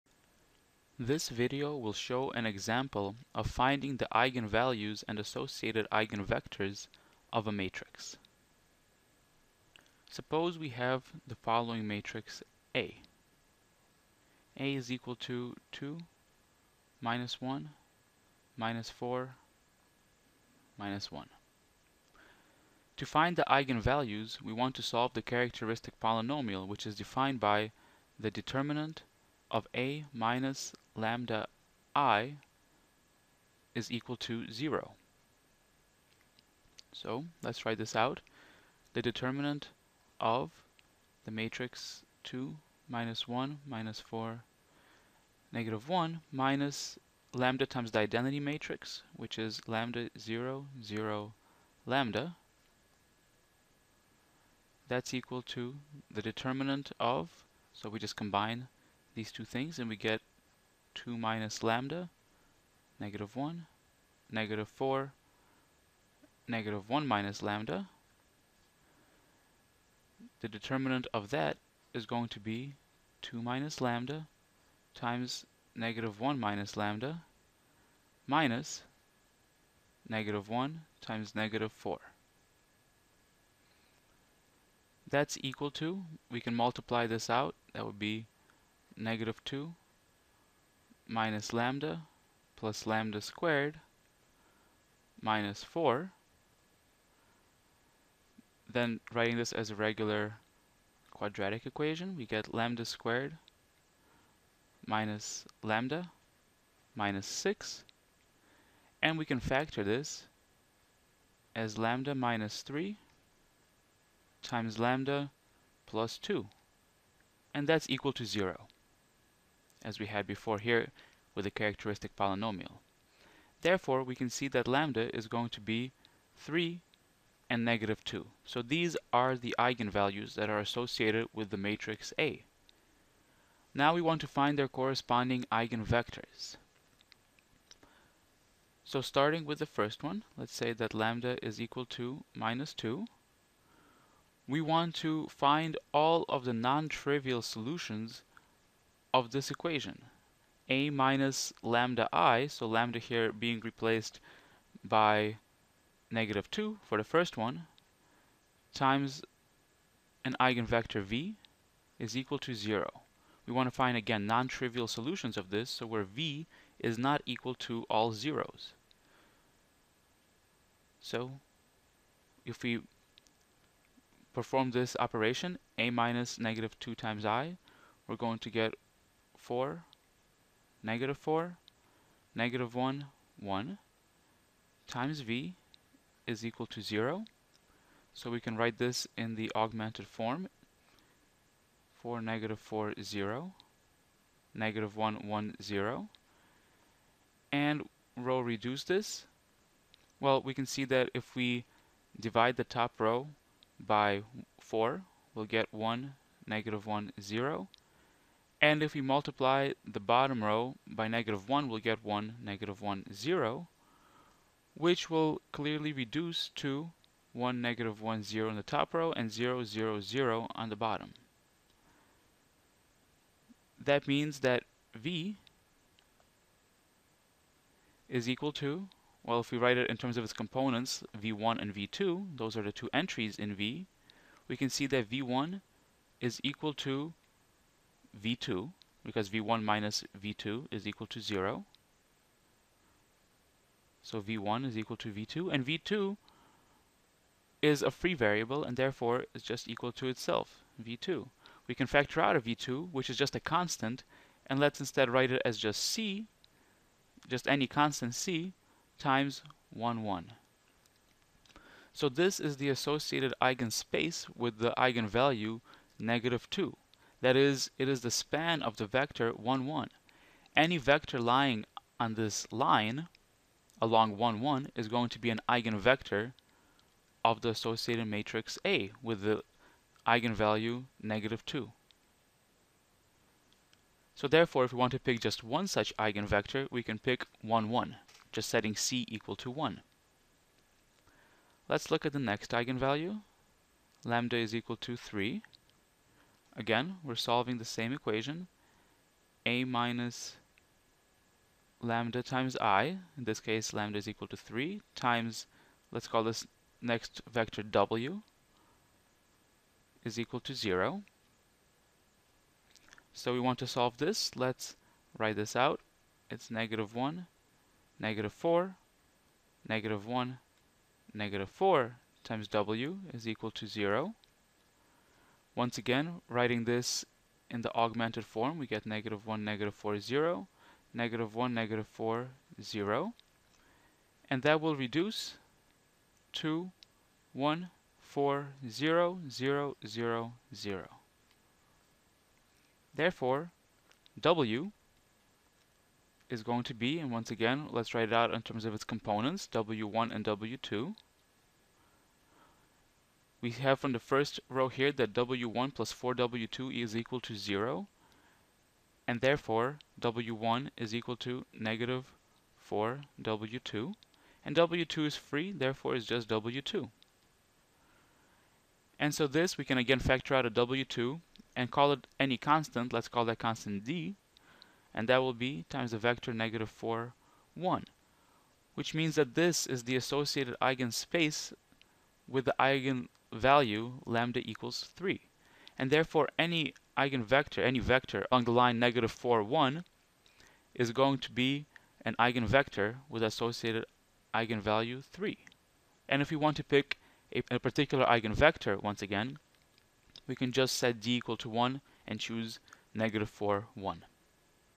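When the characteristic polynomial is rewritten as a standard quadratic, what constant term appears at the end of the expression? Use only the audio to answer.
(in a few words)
minus 6.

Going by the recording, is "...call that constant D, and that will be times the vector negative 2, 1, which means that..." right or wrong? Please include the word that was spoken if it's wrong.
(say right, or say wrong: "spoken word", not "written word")
wrong: "4", not "2".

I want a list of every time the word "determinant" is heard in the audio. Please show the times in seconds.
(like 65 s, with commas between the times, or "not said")
28 s, 39 s, 56 s, 70 s.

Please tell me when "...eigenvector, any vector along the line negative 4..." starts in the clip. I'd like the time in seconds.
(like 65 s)
386 s.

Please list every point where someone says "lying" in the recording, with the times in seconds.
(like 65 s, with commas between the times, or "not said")
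271 s.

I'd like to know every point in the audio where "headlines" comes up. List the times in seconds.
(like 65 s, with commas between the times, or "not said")
not said.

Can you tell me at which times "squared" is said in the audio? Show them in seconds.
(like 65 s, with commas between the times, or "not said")
93 s, 102 s.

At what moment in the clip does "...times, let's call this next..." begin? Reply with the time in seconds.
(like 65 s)
304 s.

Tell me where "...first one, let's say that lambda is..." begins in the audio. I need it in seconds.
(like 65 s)
139 s.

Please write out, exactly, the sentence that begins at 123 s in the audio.
Therefore, we can see that lambda is going to be 3 and negative 2.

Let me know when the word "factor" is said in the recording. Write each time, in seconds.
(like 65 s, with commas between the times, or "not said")
109 s, 251 s, 369 s.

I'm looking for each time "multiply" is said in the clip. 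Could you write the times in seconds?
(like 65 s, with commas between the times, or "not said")
86 s, 209 s.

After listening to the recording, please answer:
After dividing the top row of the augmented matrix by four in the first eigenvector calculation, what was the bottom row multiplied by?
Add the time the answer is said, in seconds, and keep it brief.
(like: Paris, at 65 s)
negative 1, at 209 s.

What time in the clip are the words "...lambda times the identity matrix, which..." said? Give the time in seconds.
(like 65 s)
47 s.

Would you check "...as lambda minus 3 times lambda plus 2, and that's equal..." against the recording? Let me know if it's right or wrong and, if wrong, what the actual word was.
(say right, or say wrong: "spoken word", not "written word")
right.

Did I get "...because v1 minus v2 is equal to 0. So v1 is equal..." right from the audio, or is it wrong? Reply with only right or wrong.
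right.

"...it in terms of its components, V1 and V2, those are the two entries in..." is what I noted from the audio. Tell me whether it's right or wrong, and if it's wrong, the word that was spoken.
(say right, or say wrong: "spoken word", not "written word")
right.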